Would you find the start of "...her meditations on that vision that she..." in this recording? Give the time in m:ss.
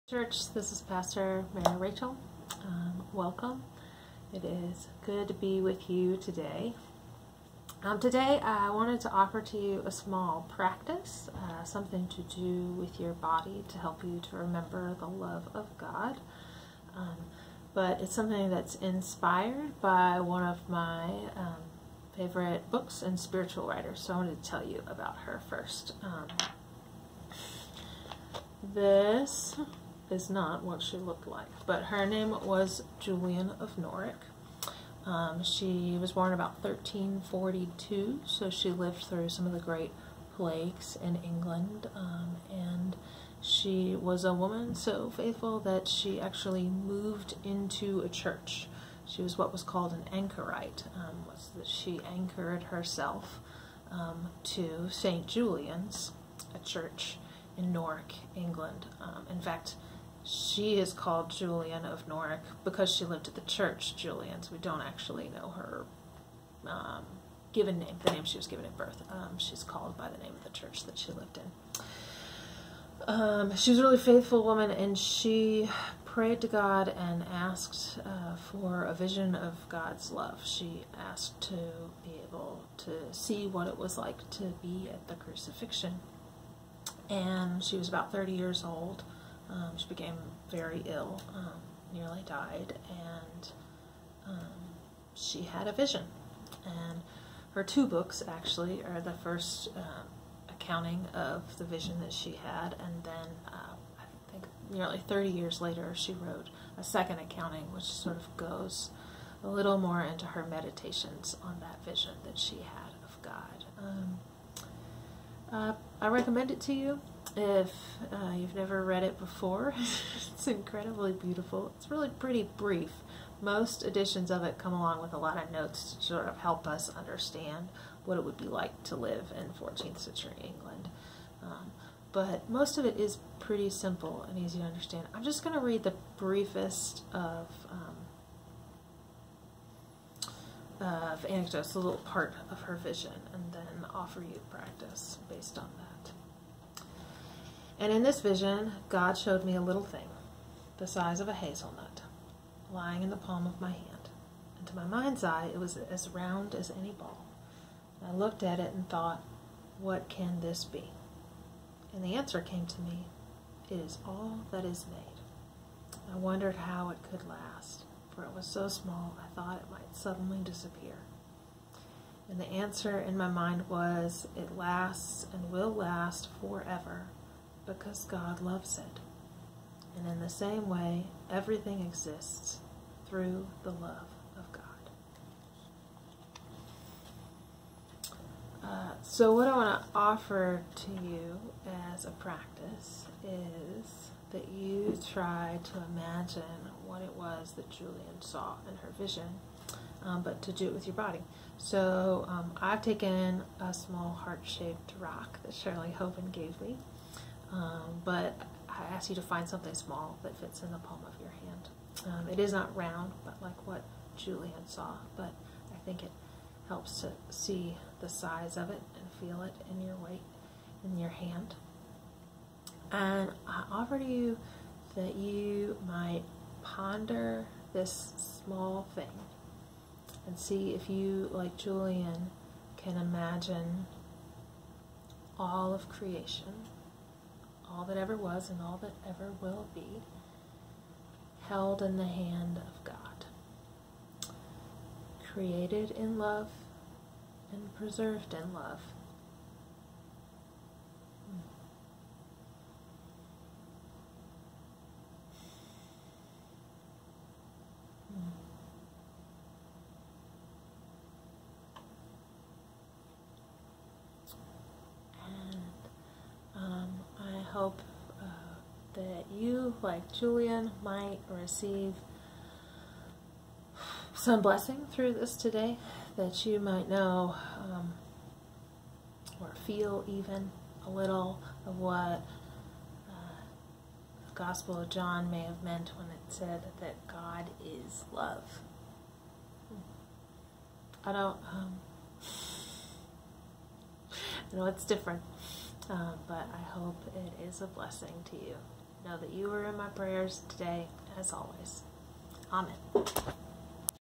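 1:50.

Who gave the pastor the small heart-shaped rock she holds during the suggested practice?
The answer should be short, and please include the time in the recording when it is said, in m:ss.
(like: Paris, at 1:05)
Shirley Hoven, at 3:25.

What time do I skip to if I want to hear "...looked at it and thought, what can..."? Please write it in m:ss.
2:38.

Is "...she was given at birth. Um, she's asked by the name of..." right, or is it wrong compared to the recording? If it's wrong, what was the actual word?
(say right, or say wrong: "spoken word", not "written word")
wrong: "called", not "asked".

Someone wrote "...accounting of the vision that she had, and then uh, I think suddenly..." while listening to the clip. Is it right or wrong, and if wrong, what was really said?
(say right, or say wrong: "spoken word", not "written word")
wrong: "nearly", not "suddenly".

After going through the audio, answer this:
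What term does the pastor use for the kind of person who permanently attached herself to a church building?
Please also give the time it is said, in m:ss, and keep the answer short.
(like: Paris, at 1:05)
Anchorite, at 0:50.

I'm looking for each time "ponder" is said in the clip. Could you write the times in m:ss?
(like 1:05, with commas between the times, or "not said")
3:46.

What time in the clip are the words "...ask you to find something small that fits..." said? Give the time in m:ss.
3:28.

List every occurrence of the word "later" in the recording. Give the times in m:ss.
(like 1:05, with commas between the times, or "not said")
1:45.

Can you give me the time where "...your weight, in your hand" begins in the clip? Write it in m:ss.
3:39.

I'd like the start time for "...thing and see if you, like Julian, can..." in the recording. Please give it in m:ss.
3:48.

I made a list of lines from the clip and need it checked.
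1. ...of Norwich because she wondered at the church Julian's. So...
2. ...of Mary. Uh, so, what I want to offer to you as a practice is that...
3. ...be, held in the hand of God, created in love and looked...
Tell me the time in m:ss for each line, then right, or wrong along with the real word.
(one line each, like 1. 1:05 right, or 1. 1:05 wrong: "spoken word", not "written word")
1. 1:01 wrong: "lived", not "wondered"
2. 3:04 wrong: "God", not "Mary"
3. 3:59 wrong: "preserved", not "looked".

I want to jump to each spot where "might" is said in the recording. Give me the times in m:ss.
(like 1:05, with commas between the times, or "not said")
2:49, 3:45, 4:30, 4:36.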